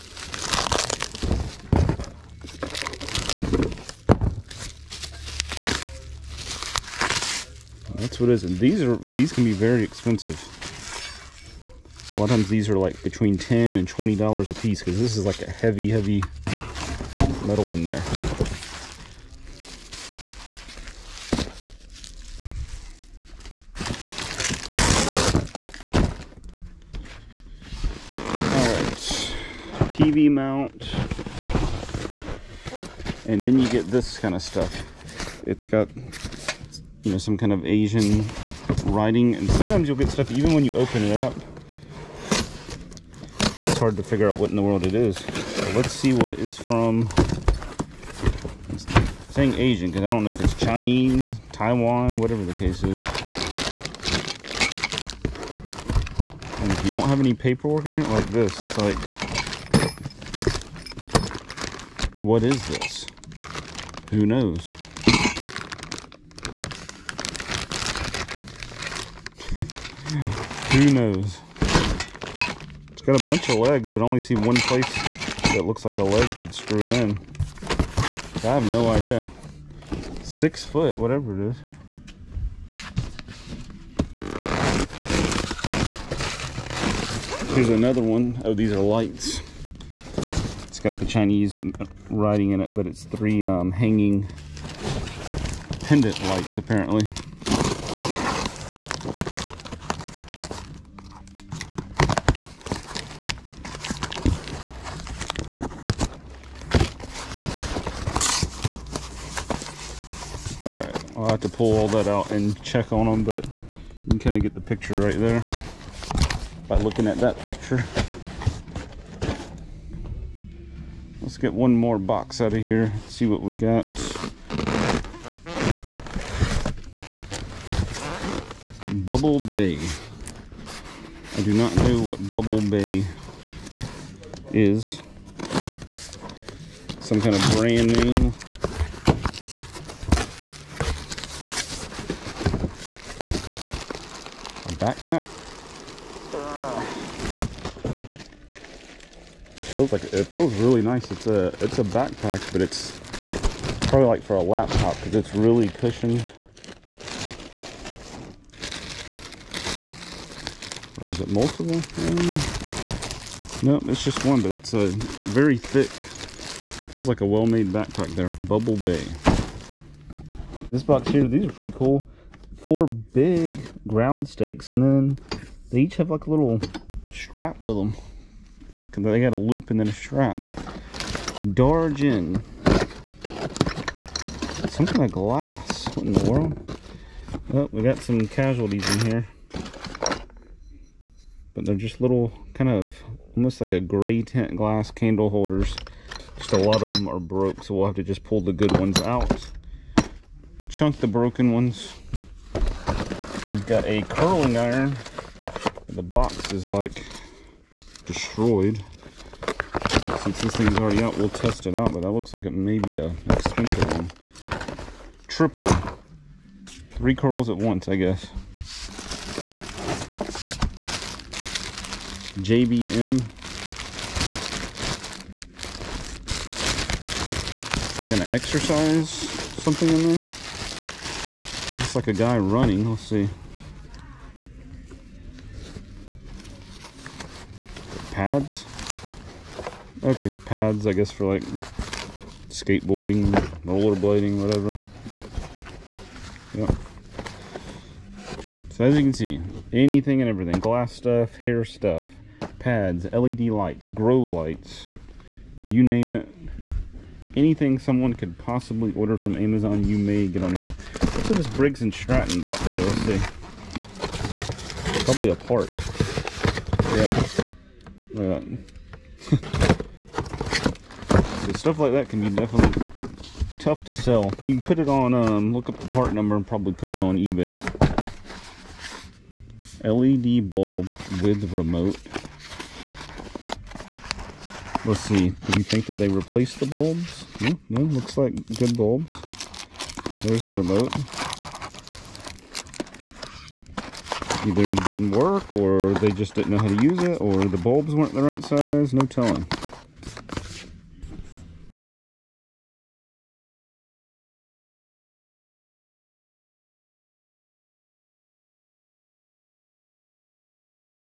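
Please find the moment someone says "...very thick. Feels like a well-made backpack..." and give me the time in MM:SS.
02:45.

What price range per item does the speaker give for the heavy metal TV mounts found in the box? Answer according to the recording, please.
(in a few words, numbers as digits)
$10 to $20.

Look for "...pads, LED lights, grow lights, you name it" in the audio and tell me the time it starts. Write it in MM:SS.
04:12.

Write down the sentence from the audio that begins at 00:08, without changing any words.
And these are these can be very expensive.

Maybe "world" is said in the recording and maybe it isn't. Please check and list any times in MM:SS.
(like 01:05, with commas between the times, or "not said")
00:44, 03:06.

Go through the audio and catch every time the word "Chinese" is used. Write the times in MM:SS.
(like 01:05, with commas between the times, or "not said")
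00:50, 01:31.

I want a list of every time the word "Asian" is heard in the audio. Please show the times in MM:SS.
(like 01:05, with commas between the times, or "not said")
00:37, 00:49.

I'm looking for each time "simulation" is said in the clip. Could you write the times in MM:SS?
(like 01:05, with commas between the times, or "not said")
not said.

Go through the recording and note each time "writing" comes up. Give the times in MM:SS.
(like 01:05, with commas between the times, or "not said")
00:38, 01:32.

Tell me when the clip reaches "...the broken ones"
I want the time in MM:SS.
03:20.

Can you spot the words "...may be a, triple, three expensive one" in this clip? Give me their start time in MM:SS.
03:32.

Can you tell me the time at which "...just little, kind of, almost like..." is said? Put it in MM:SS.
03:11.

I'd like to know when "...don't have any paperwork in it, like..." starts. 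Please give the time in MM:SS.
00:56.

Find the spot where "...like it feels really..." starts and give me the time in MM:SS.
02:29.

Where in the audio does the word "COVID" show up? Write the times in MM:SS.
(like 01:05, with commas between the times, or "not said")
not said.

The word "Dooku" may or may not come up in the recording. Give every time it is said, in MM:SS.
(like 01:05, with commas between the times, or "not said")
not said.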